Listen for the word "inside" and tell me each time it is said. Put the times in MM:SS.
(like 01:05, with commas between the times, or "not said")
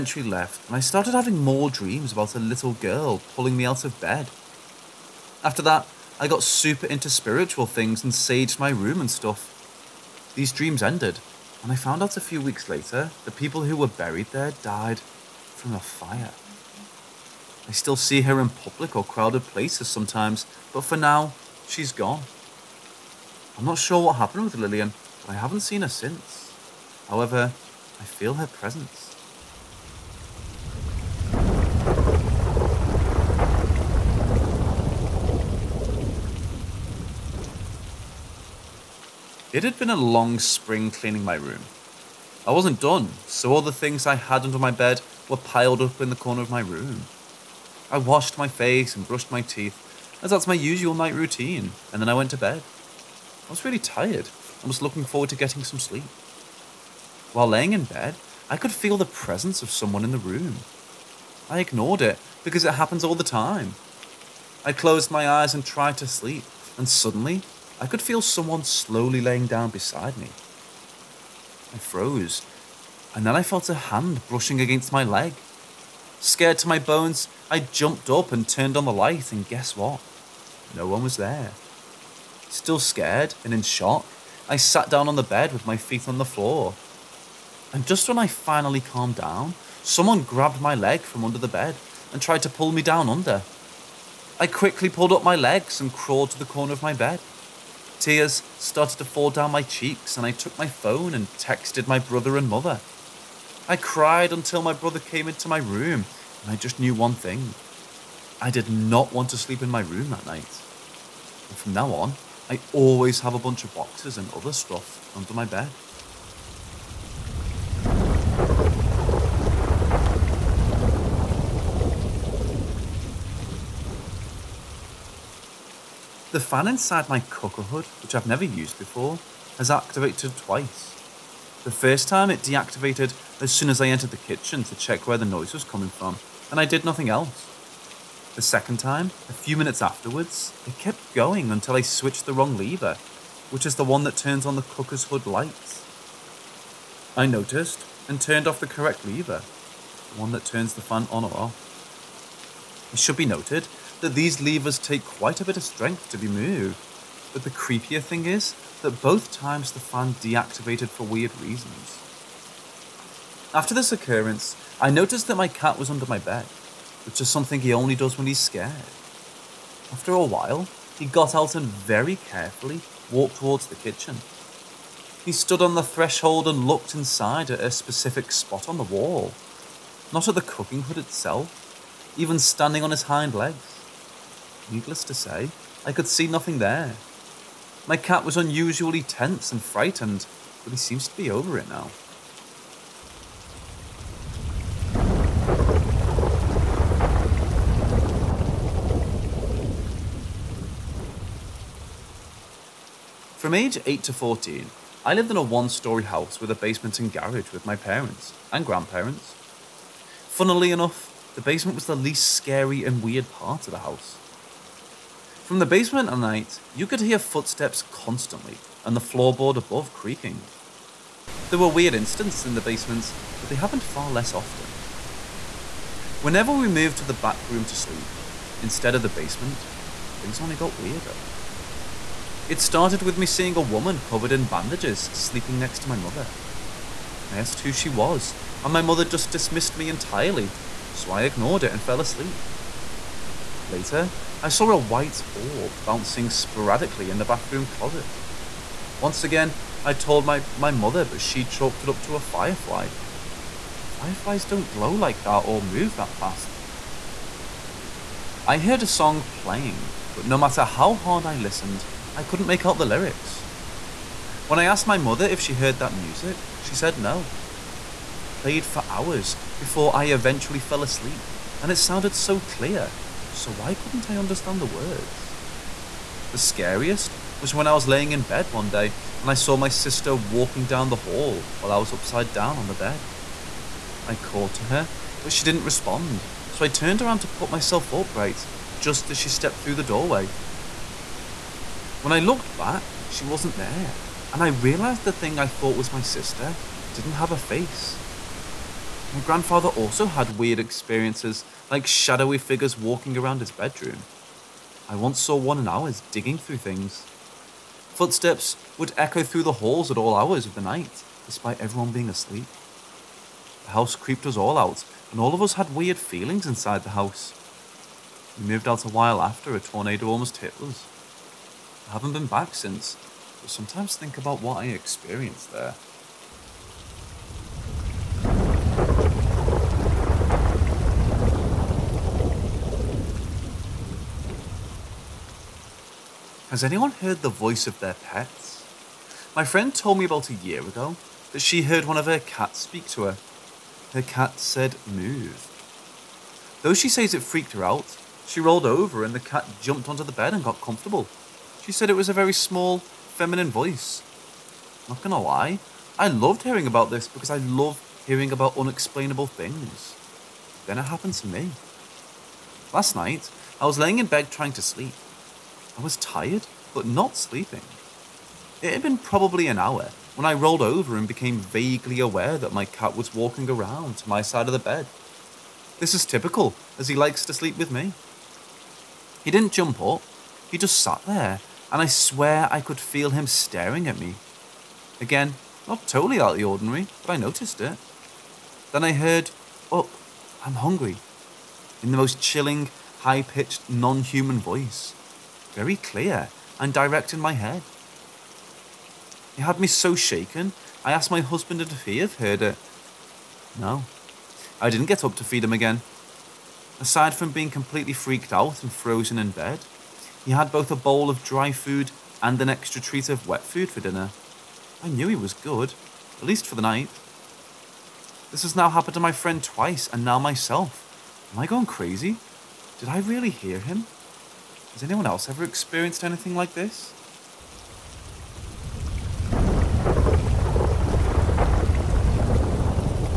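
02:06, 02:56, 05:16.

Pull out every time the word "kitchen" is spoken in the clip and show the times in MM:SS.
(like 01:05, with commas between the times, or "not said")
02:14, 02:53.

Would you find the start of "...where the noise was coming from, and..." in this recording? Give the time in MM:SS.
02:15.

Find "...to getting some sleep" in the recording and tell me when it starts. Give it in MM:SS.
00:55.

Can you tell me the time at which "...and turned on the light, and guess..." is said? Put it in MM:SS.
01:18.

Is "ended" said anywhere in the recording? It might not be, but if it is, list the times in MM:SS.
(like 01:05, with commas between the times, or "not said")
00:10.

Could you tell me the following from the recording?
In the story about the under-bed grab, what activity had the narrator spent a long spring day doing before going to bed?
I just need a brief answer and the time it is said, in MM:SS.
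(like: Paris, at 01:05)
cleaning my room, at 00:40.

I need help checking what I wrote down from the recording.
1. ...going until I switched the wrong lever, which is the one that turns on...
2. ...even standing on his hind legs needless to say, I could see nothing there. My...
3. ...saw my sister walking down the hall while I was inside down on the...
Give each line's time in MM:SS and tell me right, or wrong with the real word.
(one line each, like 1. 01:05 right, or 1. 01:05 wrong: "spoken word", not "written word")
1. 02:21 right
2. 03:02 right
3. 04:39 wrong: "upside", not "inside".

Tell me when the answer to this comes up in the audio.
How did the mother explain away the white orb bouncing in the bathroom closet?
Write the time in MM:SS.
04:12.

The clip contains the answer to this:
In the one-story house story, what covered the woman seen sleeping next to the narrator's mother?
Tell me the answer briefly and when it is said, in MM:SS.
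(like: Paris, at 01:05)
bandages, at 03:54.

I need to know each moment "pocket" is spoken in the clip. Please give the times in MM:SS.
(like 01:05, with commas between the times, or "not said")
not said.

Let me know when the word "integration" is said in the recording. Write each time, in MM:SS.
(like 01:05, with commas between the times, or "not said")
not said.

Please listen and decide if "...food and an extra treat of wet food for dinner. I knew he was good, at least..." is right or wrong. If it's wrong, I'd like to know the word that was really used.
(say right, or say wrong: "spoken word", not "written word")
right.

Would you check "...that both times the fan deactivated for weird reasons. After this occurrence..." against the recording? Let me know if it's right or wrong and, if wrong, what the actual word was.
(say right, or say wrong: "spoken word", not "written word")
right.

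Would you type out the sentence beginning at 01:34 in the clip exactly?
I quickly pulled up my legs and crawled to the corner of my bed.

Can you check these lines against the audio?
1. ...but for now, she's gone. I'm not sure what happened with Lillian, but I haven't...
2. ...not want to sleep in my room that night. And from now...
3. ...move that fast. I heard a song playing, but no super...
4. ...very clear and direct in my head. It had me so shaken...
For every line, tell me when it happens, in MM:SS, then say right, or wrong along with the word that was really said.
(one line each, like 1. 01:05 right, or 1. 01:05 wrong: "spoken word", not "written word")
1. 00:20 right
2. 01:48 right
3. 04:15 wrong: "matter", not "super"
4. 06:35 right.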